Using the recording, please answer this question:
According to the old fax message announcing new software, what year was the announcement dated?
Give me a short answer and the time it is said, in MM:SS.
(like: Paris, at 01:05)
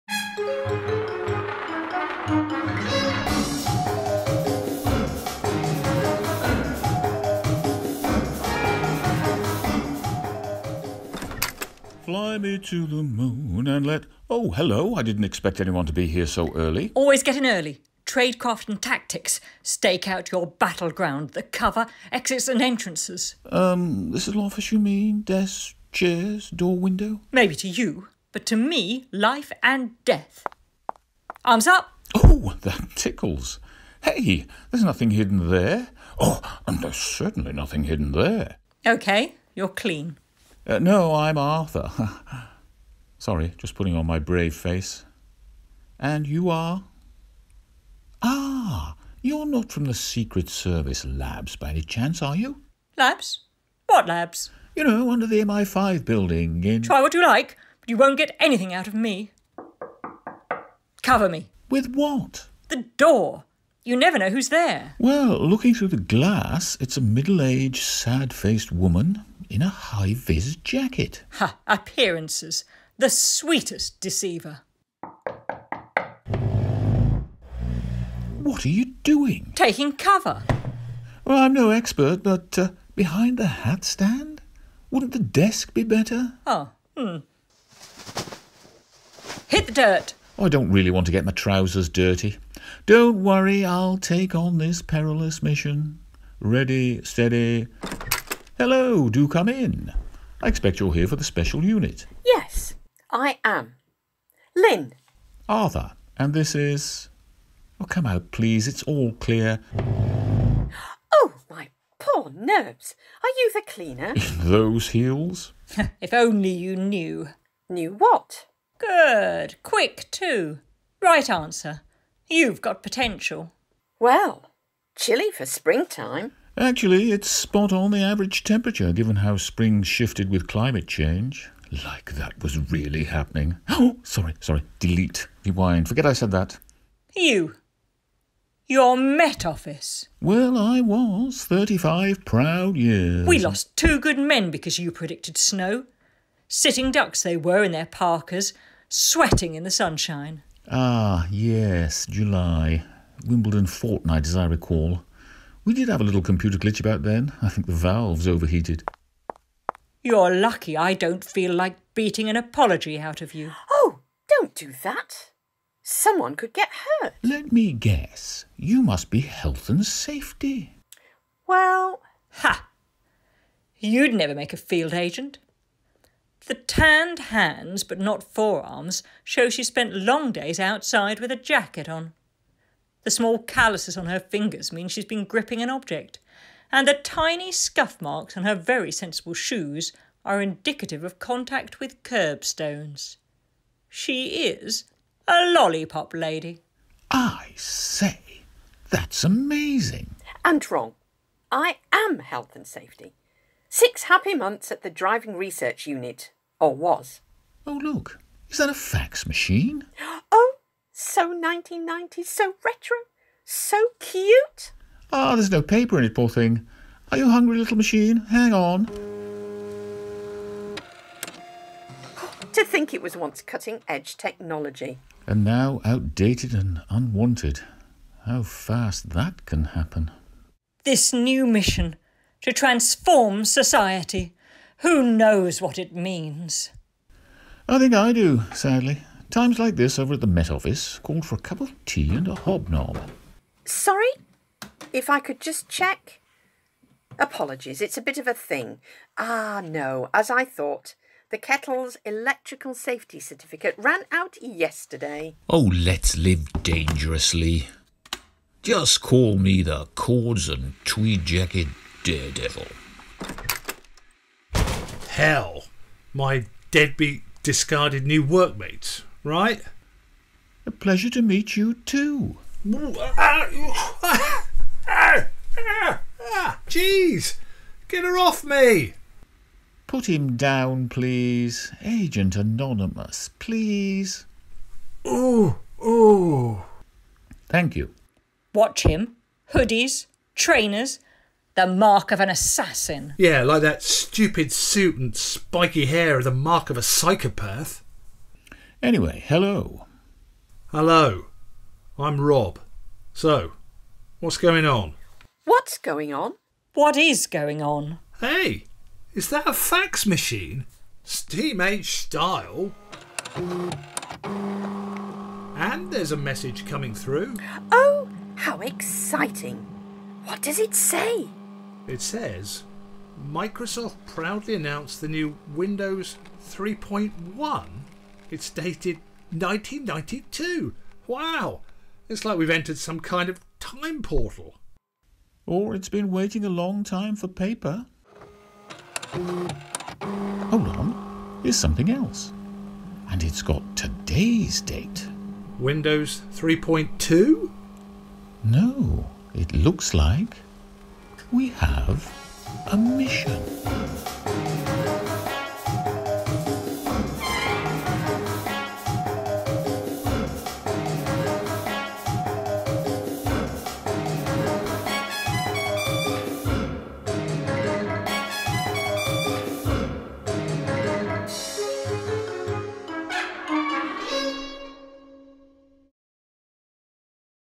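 1992, at 05:29.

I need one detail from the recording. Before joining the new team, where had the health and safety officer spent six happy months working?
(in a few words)
Driving Research Unit.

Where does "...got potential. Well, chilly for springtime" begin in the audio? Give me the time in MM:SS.
02:02.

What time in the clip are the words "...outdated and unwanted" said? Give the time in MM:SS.
03:45.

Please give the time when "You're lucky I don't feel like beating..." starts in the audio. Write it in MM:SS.
02:40.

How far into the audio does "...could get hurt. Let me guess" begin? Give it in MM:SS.
02:46.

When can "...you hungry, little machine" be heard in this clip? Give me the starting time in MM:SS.
03:37.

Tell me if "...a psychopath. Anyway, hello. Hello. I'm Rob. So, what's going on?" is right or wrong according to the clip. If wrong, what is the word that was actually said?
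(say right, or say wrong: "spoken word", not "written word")
right.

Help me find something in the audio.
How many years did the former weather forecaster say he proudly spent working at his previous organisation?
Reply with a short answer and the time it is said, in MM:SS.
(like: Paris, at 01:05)
35, at 02:21.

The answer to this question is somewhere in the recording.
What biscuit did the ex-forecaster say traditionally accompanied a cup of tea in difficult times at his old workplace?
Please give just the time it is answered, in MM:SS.
04:02.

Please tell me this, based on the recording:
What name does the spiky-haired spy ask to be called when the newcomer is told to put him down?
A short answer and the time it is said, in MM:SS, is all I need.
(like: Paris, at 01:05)
Agent Anonymous, at 04:41.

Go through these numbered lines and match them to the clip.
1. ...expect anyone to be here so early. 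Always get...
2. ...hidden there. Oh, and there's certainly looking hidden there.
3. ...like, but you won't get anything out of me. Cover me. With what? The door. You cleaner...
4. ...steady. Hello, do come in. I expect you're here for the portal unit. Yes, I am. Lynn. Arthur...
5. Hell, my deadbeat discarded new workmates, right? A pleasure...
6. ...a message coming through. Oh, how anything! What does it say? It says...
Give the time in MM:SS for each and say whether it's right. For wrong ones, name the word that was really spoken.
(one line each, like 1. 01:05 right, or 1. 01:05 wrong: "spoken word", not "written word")
1. 00:15 right
2. 00:35 wrong: "nothing", not "looking"
3. 00:57 wrong: "never", not "cleaner"
4. 01:37 wrong: "special", not "portal"
5. 04:25 right
6. 05:16 wrong: "exciting", not "anything".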